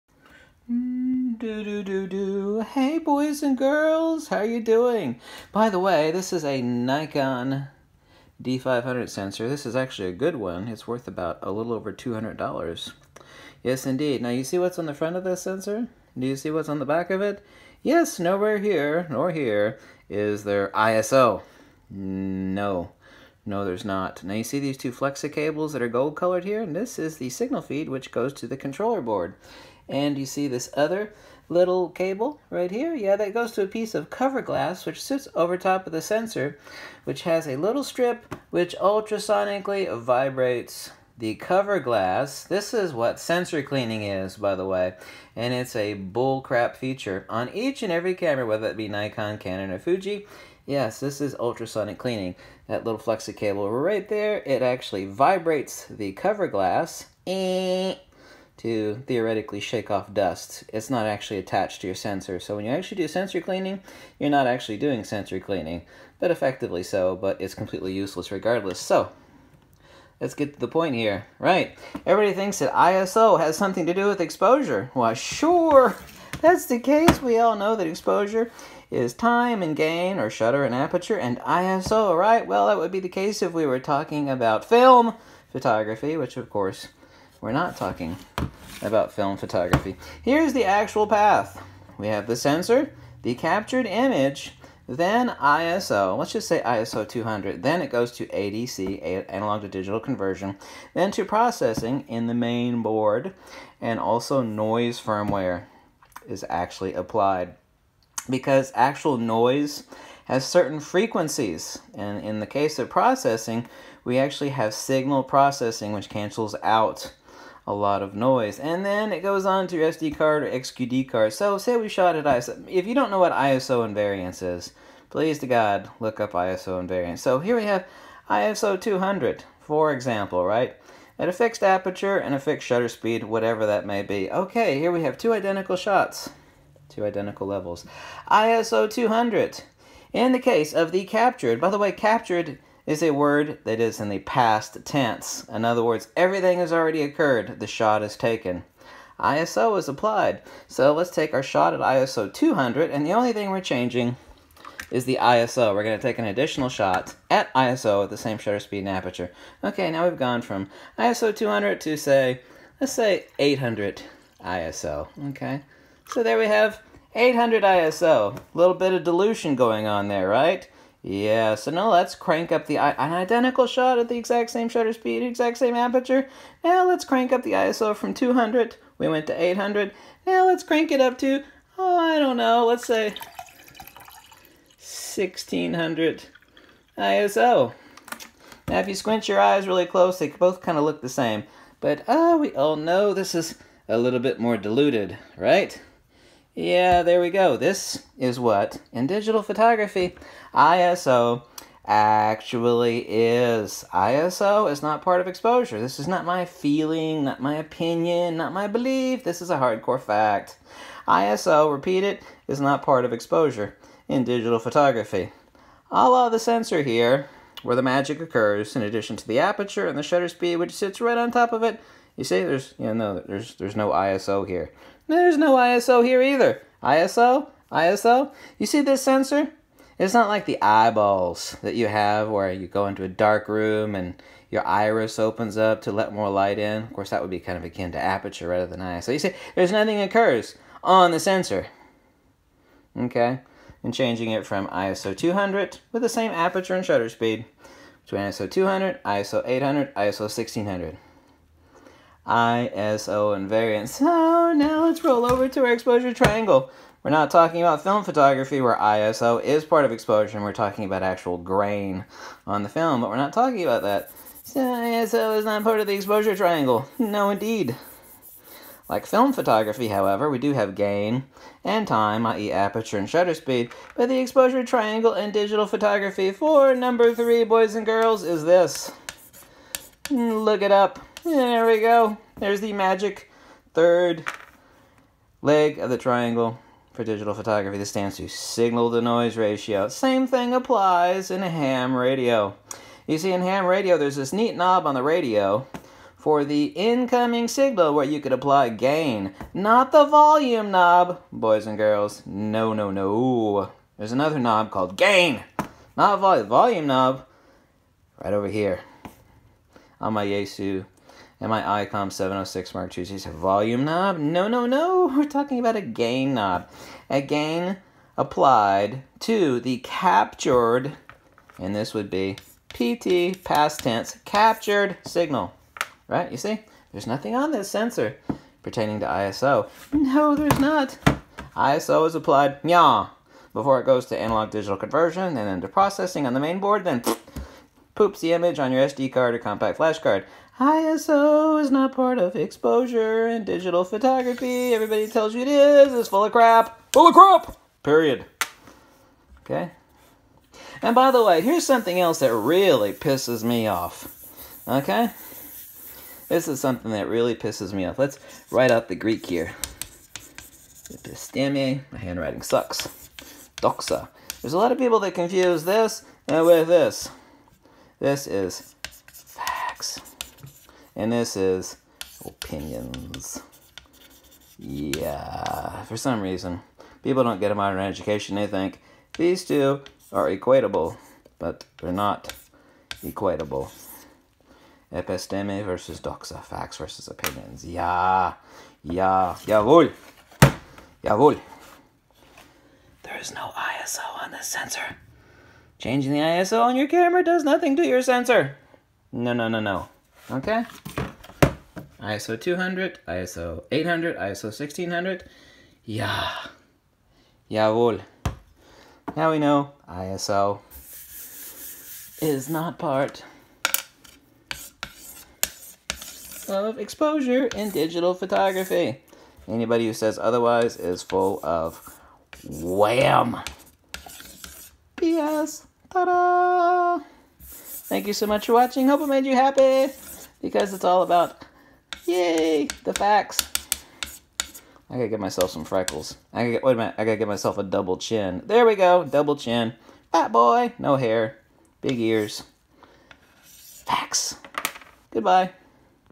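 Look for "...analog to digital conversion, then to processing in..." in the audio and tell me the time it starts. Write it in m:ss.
1:39.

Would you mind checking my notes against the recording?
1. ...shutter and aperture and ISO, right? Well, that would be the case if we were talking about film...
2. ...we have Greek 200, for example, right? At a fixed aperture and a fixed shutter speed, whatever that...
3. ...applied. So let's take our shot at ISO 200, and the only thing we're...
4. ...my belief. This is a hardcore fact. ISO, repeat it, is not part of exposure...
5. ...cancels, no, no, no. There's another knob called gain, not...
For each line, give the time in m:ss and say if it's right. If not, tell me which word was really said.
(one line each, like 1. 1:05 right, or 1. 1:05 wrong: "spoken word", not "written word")
1. 1:20 right
2. 2:07 wrong: "ISO", not "Greek"
3. 2:29 right
4. 3:28 right
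5. 5:01 wrong: "girls", not "cancels".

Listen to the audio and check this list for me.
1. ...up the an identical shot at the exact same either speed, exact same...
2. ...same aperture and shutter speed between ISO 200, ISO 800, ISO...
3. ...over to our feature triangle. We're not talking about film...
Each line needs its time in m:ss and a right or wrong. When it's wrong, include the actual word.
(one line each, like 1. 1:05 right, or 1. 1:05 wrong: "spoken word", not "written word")
1. 2:52 wrong: "shutter", not "either"
2. 4:06 right
3. 4:15 wrong: "exposure", not "feature".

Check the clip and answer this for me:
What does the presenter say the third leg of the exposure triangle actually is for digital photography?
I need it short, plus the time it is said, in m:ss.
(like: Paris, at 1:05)
Signal to noise ratio, at 4:48.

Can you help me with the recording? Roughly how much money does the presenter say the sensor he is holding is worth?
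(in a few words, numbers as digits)
A little over $200.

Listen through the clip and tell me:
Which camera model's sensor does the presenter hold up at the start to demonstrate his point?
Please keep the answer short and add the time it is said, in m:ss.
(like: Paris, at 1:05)
Nikon D500, at 0:06.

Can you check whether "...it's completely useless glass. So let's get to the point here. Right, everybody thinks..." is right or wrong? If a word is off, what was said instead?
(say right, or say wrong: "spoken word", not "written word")
wrong: "regardless", not "glass".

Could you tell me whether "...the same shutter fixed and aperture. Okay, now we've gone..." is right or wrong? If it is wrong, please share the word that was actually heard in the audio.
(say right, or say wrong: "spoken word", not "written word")
wrong: "speed", not "fixed".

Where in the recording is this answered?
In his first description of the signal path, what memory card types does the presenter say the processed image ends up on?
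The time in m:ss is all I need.
1:59.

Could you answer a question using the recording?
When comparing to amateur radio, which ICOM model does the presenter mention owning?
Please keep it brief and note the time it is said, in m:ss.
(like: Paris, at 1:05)
ICOM 706 Mark II, at 5:11.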